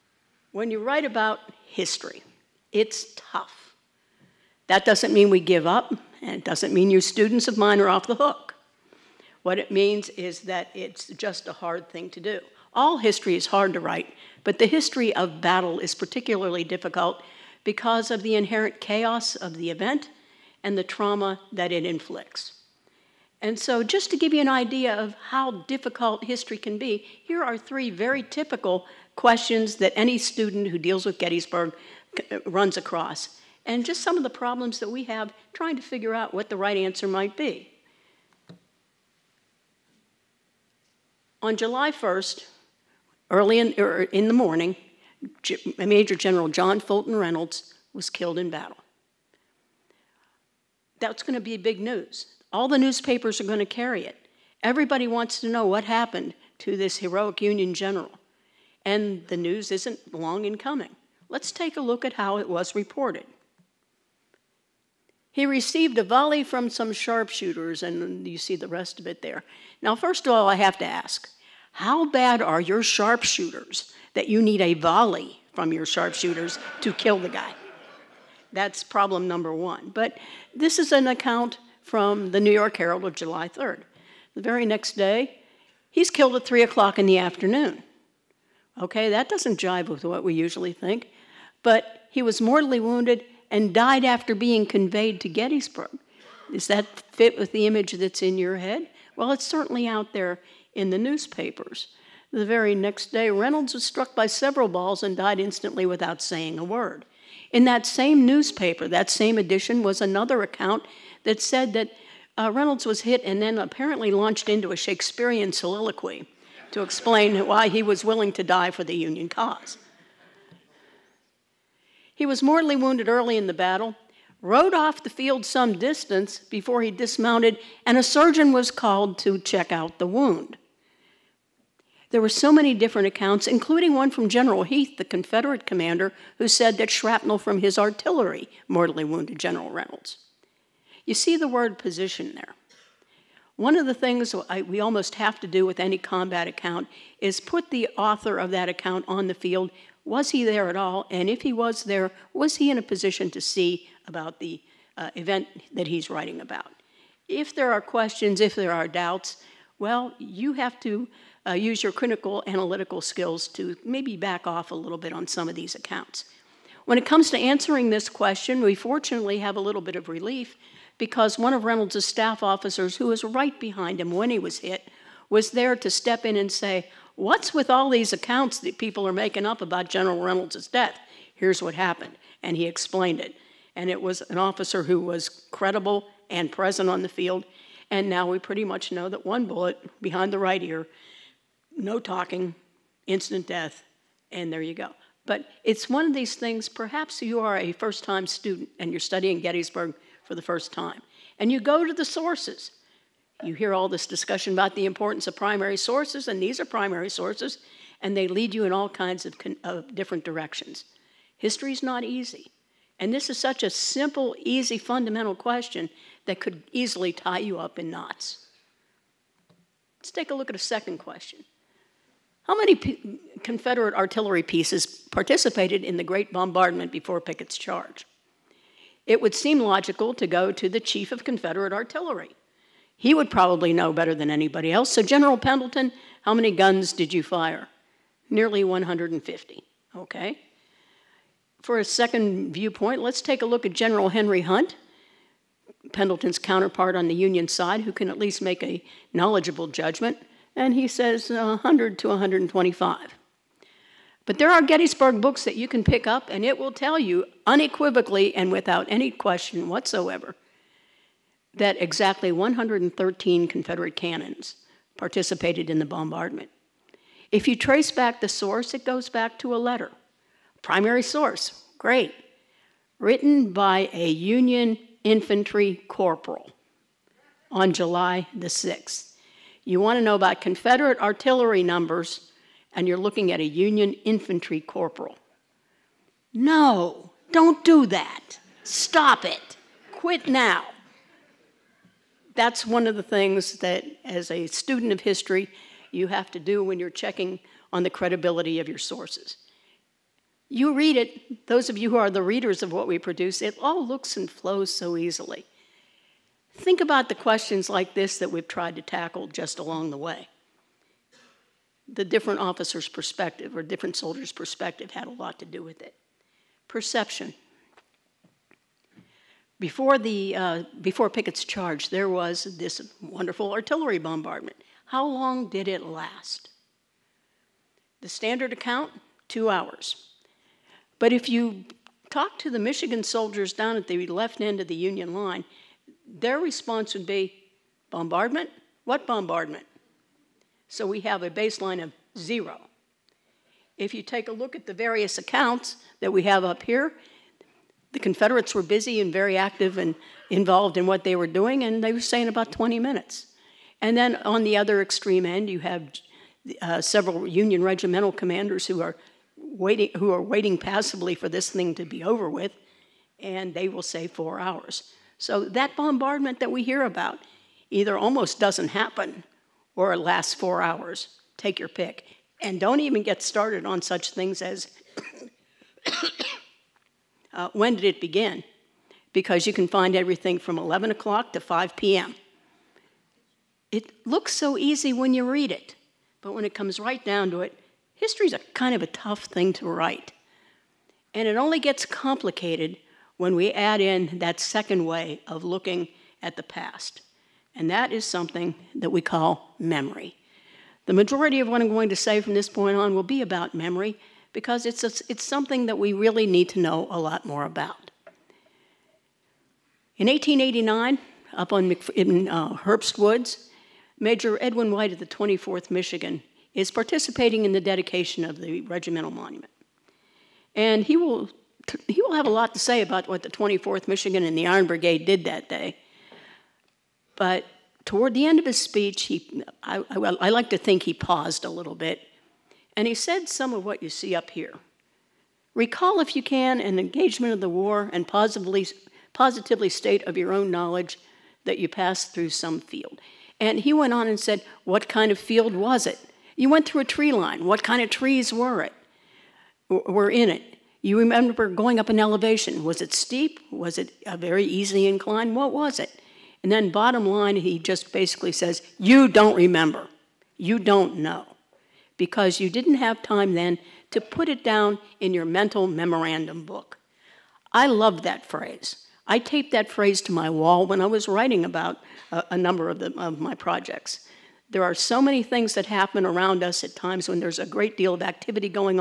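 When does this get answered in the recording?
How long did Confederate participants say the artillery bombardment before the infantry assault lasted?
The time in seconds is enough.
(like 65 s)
352 s.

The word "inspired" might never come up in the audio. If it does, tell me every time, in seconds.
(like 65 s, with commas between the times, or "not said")
not said.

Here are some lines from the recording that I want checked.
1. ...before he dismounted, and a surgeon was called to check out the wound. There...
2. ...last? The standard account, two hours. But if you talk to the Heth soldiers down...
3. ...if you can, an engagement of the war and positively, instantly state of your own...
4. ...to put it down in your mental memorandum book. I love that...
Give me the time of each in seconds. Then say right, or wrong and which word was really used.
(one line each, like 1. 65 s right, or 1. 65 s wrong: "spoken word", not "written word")
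1. 126 s right
2. 325 s wrong: "Michigan", not "Heth"
3. 436 s wrong: "positively", not "instantly"
4. 463 s right.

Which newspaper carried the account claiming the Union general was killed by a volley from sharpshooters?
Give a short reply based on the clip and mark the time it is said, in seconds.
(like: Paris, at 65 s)
New York Herald, at 82 s.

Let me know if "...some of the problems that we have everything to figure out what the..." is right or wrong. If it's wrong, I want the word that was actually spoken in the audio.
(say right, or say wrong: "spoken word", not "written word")
wrong: "trying", not "everything".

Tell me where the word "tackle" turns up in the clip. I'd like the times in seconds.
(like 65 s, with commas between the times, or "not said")
308 s.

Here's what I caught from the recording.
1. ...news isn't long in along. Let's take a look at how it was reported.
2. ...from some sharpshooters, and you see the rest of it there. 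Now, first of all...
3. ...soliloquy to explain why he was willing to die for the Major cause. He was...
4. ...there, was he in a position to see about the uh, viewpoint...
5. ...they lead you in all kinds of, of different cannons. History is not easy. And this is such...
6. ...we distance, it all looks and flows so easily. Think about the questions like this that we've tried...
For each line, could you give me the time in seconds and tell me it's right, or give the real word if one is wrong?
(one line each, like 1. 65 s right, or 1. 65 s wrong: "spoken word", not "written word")
1. 59 s wrong: "coming", not "along"
2. 66 s right
3. 115 s wrong: "Union", not "Major"
4. 151 s wrong: "event", not "viewpoint"
5. 208 s wrong: "directions", not "cannons"
6. 302 s wrong: "produce", not "distance".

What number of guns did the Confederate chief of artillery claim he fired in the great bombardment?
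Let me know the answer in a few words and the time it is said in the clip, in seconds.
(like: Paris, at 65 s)
Nearly 150, at 238 s.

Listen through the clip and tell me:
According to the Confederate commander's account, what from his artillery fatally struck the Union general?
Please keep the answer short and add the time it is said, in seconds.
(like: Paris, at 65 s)
Shrapnel, at 136 s.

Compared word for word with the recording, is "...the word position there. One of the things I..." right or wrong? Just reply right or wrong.
right.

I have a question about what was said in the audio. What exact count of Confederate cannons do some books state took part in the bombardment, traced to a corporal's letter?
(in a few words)
113.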